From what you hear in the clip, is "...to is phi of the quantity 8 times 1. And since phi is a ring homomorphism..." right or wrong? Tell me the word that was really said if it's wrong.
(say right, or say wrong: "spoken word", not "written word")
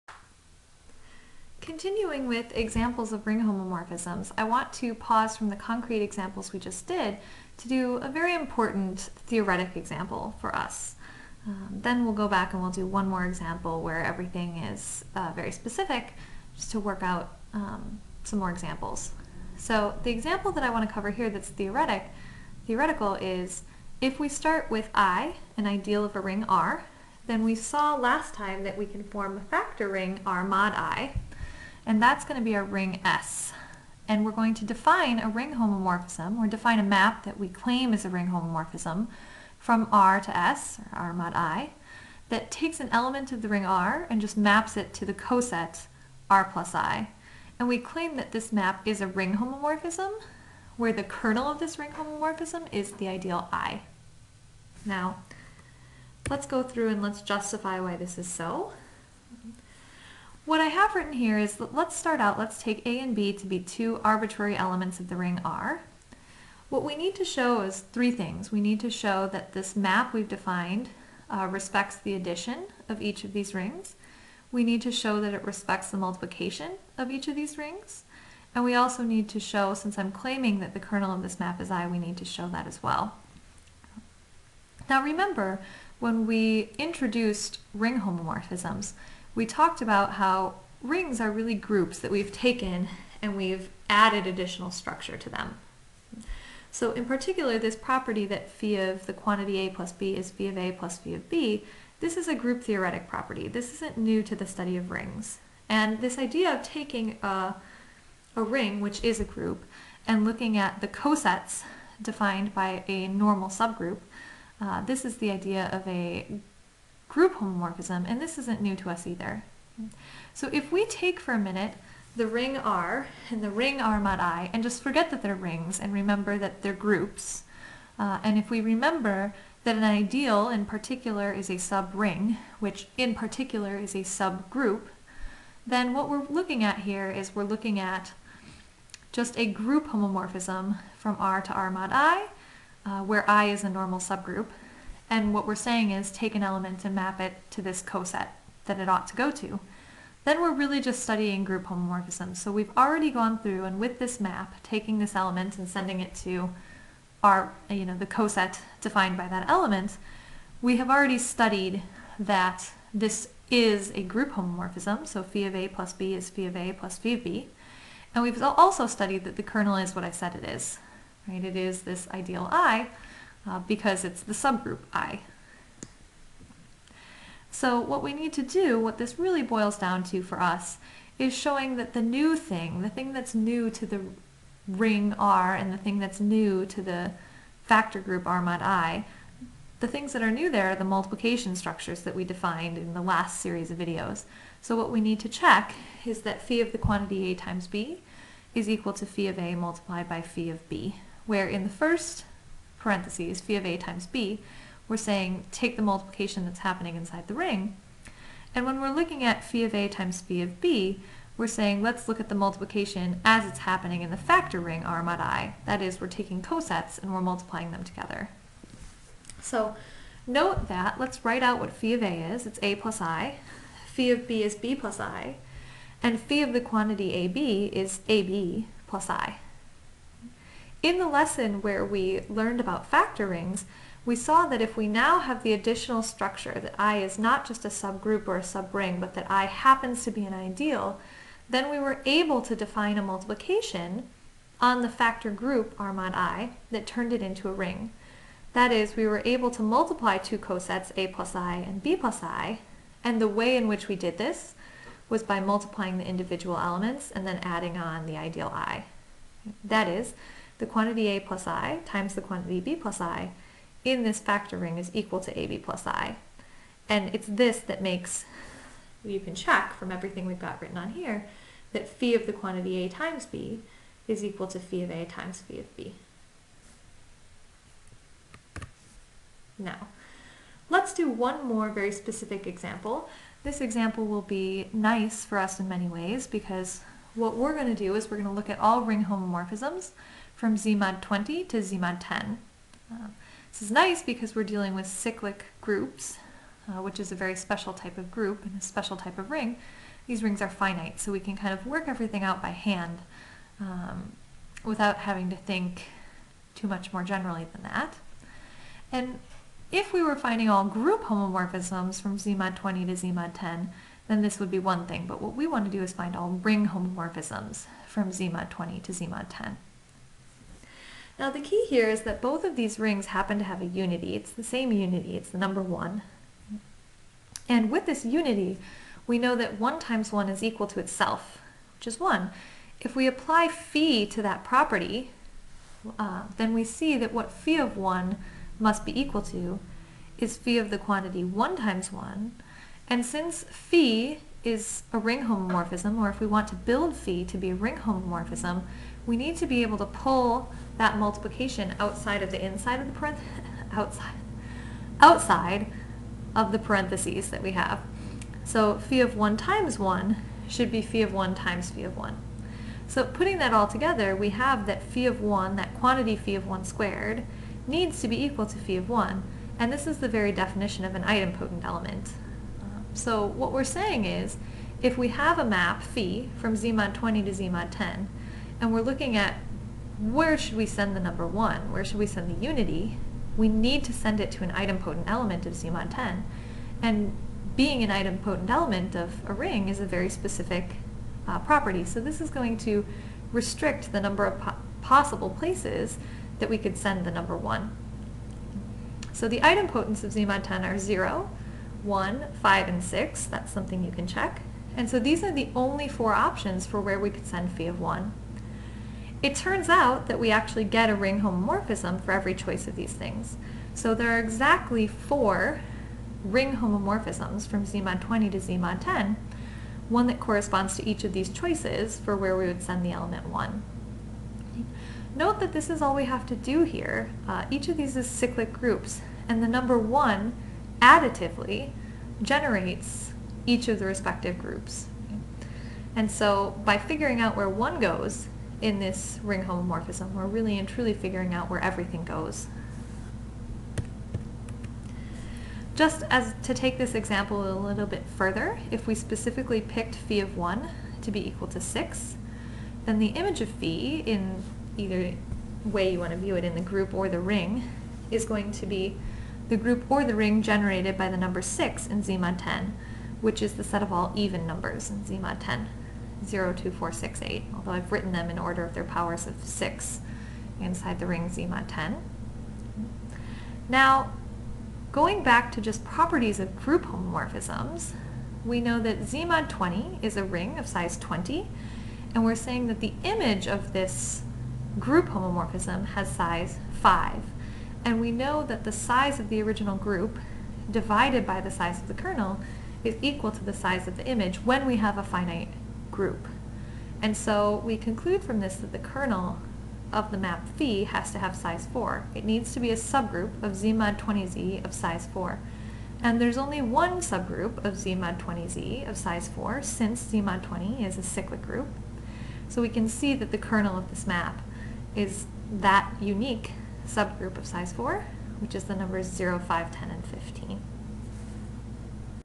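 wrong: "1", not "8".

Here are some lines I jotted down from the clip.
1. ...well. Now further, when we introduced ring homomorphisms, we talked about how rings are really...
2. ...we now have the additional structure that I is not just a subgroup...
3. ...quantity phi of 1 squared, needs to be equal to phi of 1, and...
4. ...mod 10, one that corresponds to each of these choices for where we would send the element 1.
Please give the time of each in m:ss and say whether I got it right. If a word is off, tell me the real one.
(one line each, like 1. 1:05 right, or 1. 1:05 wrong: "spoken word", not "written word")
1. 1:22 wrong: "remember", not "further"
2. 3:54 right
3. 6:05 right
4. 6:58 right.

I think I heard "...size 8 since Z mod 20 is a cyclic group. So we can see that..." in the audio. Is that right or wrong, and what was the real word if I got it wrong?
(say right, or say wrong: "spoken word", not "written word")
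wrong: "4", not "8".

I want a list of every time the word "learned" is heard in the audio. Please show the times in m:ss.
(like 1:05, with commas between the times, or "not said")
3:52.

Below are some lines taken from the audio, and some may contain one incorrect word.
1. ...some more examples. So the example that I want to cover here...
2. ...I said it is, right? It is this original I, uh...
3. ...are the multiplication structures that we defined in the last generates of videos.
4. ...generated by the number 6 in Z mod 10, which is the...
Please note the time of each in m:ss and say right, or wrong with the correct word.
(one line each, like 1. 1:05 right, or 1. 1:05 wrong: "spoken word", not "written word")
1. 0:18 right
2. 2:50 wrong: "ideal", not "original"
3. 3:10 wrong: "series", not "generates"
4. 7:40 right.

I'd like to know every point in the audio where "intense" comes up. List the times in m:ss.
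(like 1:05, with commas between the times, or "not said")
not said.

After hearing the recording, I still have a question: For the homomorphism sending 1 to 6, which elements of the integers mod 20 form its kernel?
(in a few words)
0, 5, 10, and 15.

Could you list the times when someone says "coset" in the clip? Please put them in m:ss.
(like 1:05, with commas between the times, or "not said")
0:45, 1:50, 2:27, 2:38, 3:36, 4:10.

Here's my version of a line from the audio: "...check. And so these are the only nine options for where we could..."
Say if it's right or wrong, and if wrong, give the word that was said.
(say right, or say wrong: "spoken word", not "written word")
wrong: "four", not "nine".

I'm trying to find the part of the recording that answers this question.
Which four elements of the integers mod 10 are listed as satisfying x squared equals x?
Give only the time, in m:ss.
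6:40.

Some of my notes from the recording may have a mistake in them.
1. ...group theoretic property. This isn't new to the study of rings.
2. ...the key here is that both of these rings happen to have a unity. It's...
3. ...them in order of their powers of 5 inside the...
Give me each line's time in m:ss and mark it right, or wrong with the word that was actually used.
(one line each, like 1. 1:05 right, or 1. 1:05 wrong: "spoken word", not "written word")
1. 1:42 right
2. 5:21 right
3. 7:48 wrong: "6", not "5".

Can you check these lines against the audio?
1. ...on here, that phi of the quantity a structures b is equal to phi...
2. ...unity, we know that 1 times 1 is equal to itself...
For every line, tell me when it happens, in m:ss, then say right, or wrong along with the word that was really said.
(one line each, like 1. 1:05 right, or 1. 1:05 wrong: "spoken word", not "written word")
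1. 4:30 wrong: "times", not "structures"
2. 5:28 right.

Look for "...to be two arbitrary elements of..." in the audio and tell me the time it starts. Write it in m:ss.
1:03.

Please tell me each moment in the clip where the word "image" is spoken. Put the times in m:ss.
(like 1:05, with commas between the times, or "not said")
7:33, 8:03, 8:14.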